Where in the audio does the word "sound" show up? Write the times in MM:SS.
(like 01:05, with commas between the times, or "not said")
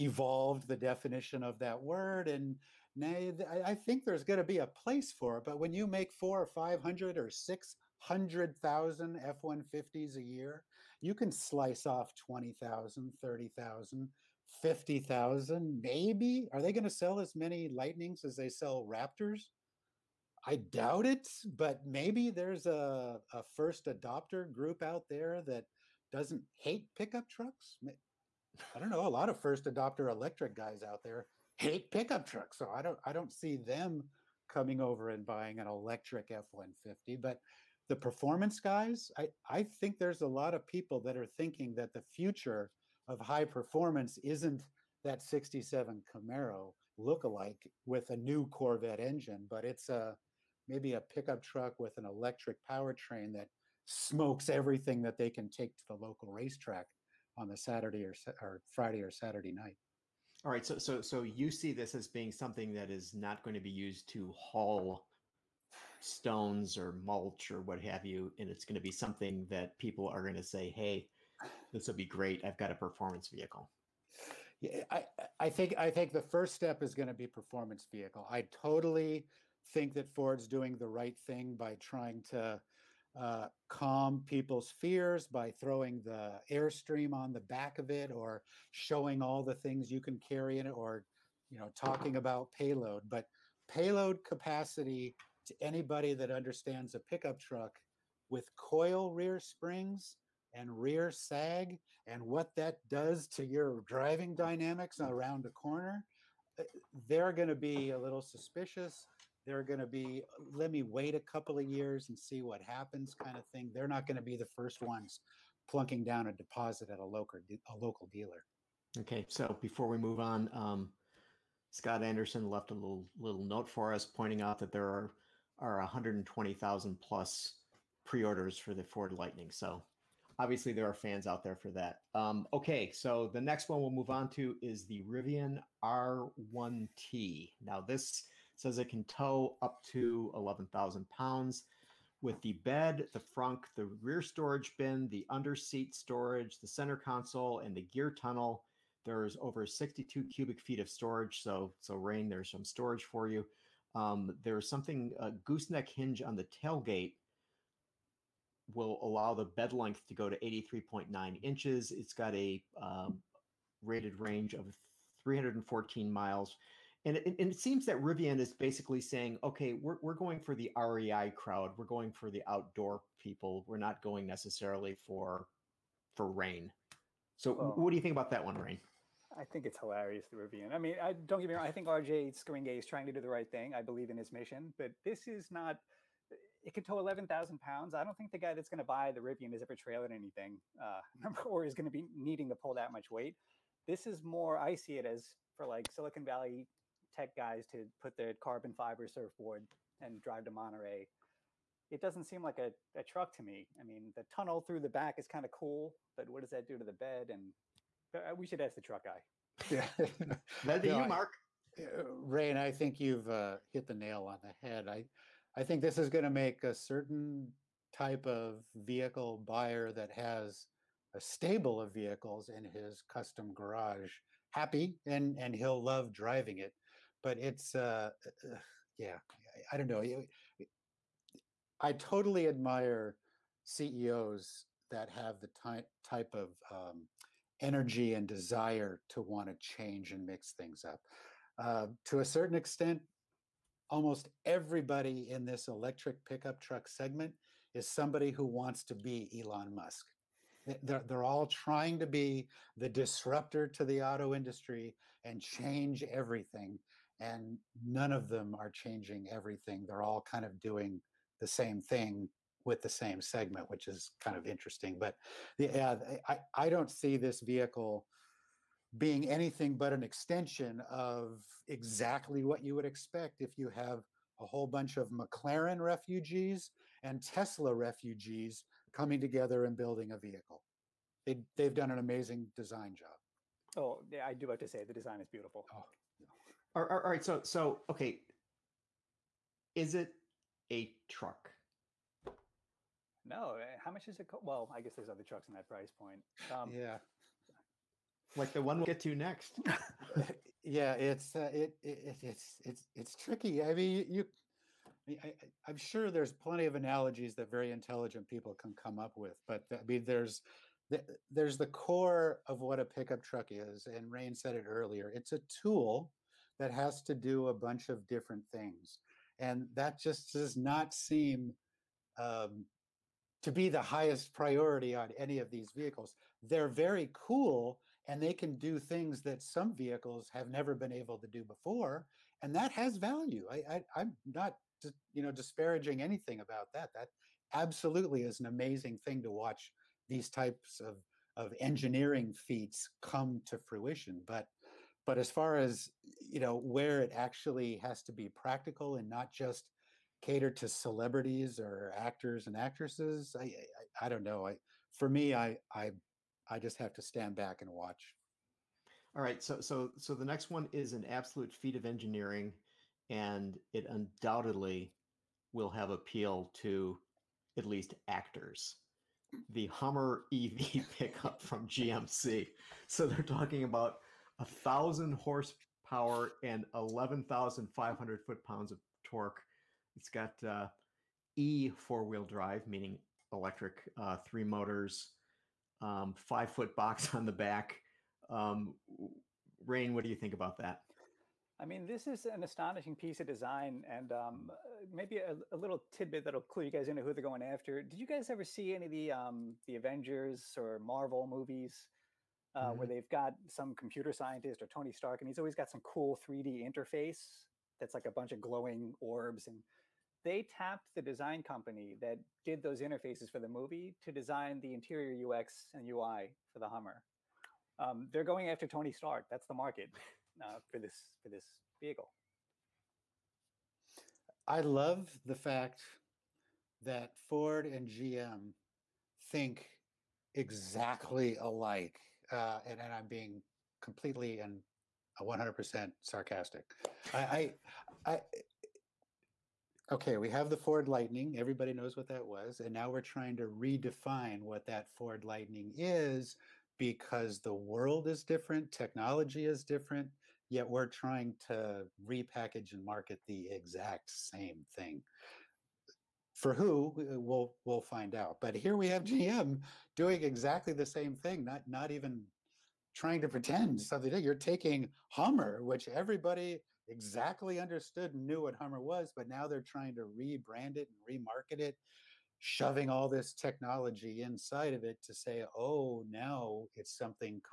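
not said.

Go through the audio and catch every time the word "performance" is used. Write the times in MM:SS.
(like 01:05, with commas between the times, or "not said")
00:37, 00:43, 01:12, 01:17.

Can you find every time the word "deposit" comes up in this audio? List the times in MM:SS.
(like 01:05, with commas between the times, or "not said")
01:56.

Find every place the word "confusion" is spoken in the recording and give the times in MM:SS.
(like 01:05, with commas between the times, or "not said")
not said.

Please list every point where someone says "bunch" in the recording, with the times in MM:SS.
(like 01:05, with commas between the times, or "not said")
04:34, 05:17, 06:48.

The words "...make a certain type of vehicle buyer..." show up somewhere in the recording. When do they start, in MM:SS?
03:36.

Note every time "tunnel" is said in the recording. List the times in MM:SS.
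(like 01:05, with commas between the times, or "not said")
02:28, 03:24.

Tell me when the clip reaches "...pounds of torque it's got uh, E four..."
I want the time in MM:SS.
06:18.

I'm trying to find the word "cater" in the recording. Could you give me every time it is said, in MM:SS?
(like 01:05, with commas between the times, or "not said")
05:50.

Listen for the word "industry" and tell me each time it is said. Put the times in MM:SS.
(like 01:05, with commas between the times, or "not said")
04:14.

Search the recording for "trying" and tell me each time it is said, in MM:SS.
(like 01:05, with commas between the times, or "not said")
01:21, 03:02, 04:11, 07:23, 07:30, 07:42, 07:49.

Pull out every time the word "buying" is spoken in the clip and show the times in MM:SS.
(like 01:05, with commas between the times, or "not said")
00:35.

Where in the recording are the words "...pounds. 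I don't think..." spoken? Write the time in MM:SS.
03:07.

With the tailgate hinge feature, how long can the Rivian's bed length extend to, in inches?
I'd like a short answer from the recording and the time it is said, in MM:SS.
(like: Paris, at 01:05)
83.9 inches, at 02:40.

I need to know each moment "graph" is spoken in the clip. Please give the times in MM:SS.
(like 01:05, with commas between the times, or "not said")
not said.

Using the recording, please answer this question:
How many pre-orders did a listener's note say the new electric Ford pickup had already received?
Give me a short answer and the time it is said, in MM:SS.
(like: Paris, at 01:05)
120,000 plus, at 02:05.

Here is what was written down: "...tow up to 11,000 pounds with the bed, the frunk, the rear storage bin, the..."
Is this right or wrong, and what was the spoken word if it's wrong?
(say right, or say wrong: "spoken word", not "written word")
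right.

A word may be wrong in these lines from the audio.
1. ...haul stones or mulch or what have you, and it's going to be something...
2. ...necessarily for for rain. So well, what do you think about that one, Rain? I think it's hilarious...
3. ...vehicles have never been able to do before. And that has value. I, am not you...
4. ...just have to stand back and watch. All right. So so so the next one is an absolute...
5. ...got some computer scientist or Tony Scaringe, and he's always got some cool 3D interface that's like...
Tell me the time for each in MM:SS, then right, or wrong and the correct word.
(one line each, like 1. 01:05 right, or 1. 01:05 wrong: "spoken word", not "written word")
1. 01:04 right
2. 02:54 right
3. 05:29 right
4. 05:56 right
5. 06:43 wrong: "Stark", not "Scaringe".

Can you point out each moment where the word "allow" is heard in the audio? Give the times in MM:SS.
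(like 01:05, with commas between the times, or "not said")
02:39.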